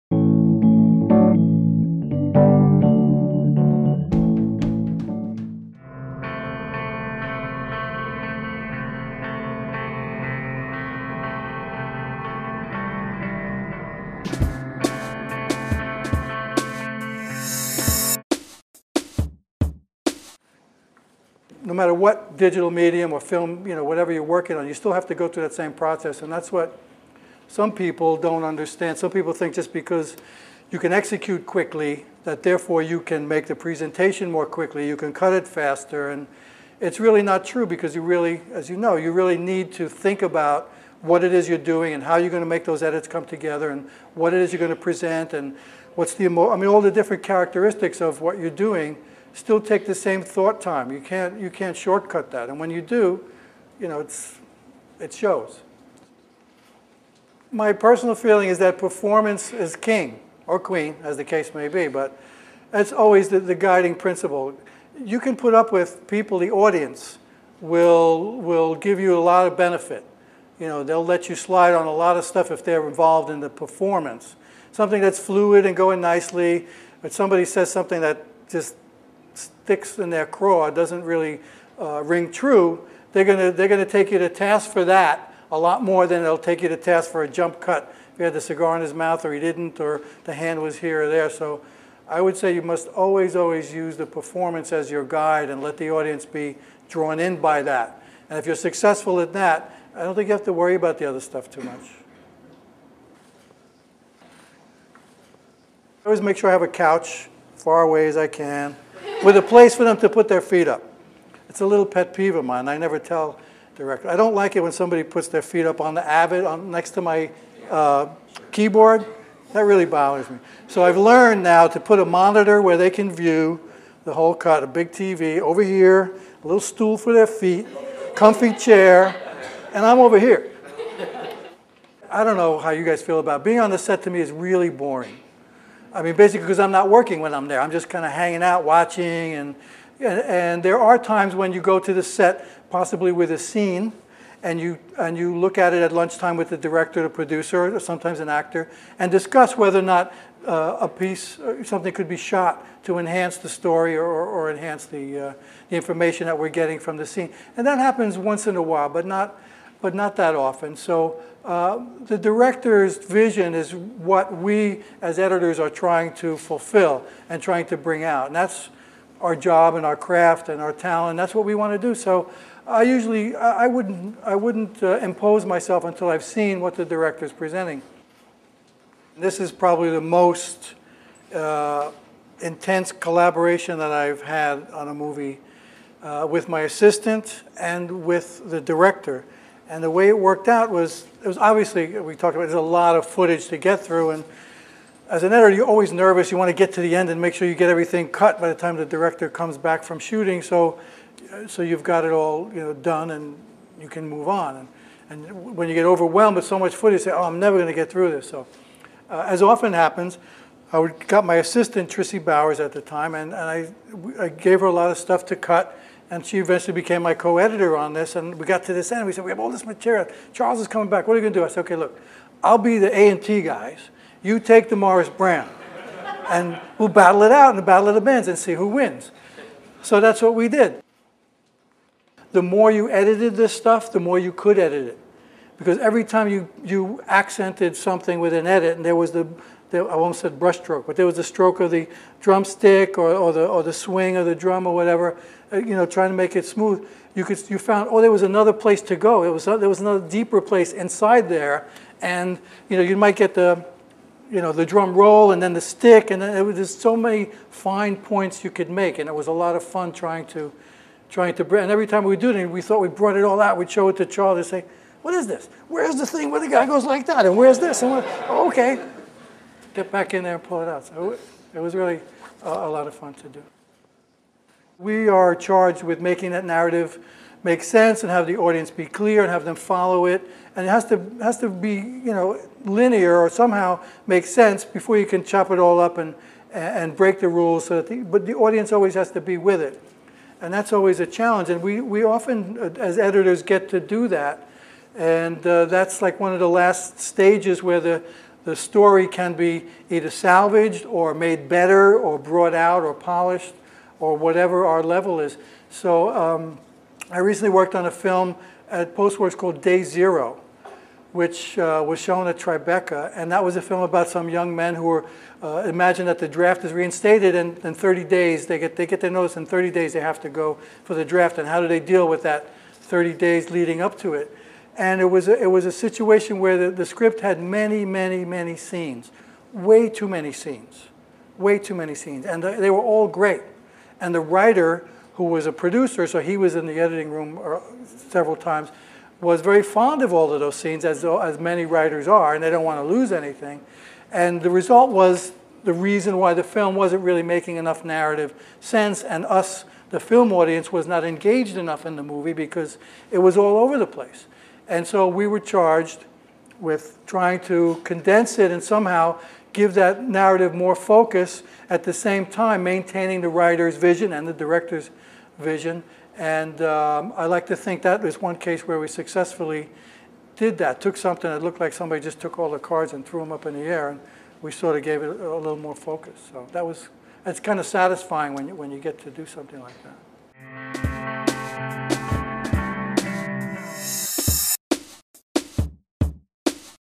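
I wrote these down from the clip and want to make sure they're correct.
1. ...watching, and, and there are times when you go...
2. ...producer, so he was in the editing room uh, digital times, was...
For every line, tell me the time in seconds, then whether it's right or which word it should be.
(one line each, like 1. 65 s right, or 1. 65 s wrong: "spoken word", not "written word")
1. 138 s right
2. 335 s wrong: "several", not "digital".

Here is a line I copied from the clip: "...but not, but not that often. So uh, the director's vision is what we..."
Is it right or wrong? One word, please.
right.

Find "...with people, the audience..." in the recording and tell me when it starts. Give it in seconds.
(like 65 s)
65 s.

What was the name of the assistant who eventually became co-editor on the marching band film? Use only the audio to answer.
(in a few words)
Trissy Bowers.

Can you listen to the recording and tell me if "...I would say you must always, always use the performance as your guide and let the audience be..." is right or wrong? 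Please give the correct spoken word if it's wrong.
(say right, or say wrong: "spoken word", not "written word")
right.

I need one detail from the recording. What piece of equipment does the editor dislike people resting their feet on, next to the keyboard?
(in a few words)
The Avid.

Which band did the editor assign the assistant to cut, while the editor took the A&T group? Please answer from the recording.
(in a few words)
Morris Brown.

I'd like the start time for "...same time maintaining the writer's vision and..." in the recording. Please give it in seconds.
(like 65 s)
361 s.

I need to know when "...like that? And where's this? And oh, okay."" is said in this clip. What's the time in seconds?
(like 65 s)
266 s.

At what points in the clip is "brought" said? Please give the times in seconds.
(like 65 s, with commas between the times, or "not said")
262 s, 302 s.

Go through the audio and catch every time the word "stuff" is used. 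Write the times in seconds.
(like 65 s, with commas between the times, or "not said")
72 s, 101 s, 214 s, 233 s.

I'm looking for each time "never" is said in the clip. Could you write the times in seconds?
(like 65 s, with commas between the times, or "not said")
112 s, 207 s.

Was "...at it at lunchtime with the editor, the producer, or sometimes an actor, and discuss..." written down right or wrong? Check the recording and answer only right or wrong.
wrong.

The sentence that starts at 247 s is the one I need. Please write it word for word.
You, could, you found, oh, there was another place to go.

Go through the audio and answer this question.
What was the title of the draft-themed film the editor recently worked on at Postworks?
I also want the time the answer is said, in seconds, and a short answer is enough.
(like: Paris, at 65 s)
Day Zero, at 309 s.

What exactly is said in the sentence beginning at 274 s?
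We are charged with making that narrative make sense and have the audience be clear and have them follow it.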